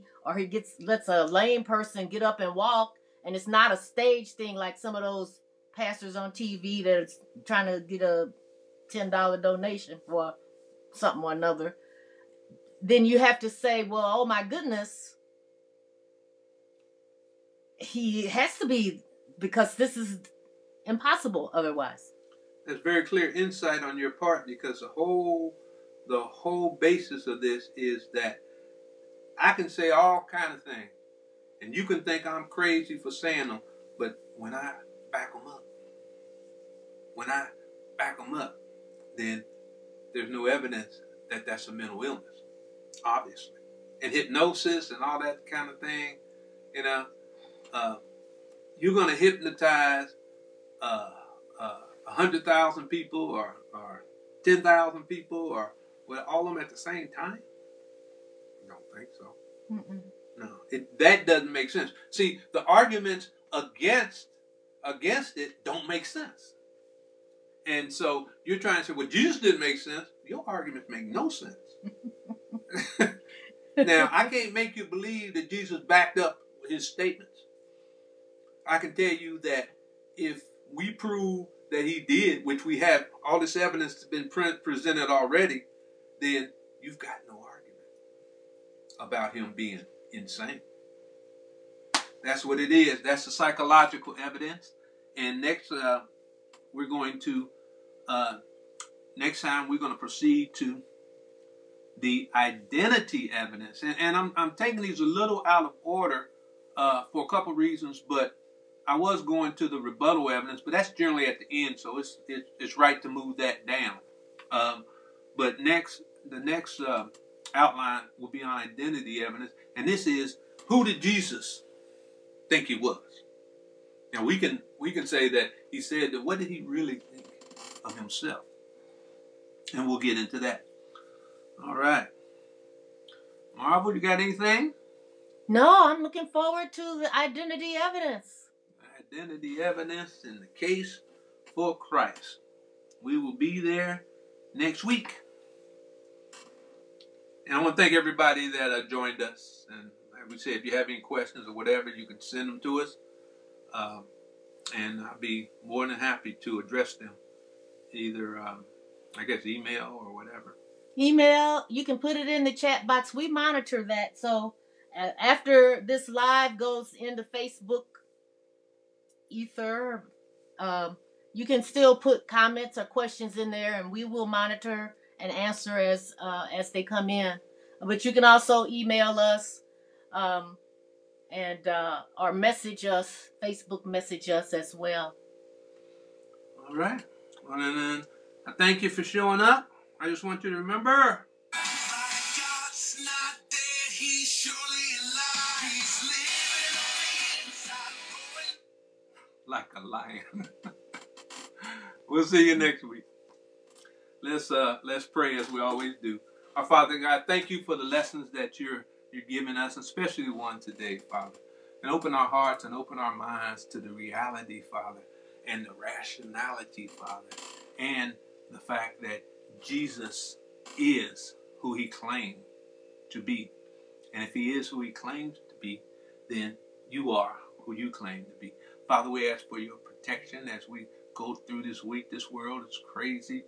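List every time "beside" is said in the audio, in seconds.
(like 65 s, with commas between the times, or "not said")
not said.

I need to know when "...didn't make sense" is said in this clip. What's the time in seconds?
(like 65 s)
69 s.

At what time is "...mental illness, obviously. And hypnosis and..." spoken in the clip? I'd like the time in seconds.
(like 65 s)
41 s.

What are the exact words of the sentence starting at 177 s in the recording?
But you can also email us um, and uh, or message us, Facebook message us as well.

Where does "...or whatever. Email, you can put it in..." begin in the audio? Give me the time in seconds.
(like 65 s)
160 s.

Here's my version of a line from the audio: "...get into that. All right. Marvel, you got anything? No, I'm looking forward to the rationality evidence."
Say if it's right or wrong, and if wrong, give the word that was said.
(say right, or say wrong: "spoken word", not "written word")
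wrong: "identity", not "rationality".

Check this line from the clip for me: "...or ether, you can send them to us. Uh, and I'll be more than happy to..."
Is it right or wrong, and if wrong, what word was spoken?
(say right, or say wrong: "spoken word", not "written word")
wrong: "whatever", not "ether".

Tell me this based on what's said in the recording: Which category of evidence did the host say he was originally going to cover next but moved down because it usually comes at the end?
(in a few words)
rebuttal evidence.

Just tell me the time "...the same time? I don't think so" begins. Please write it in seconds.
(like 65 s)
56 s.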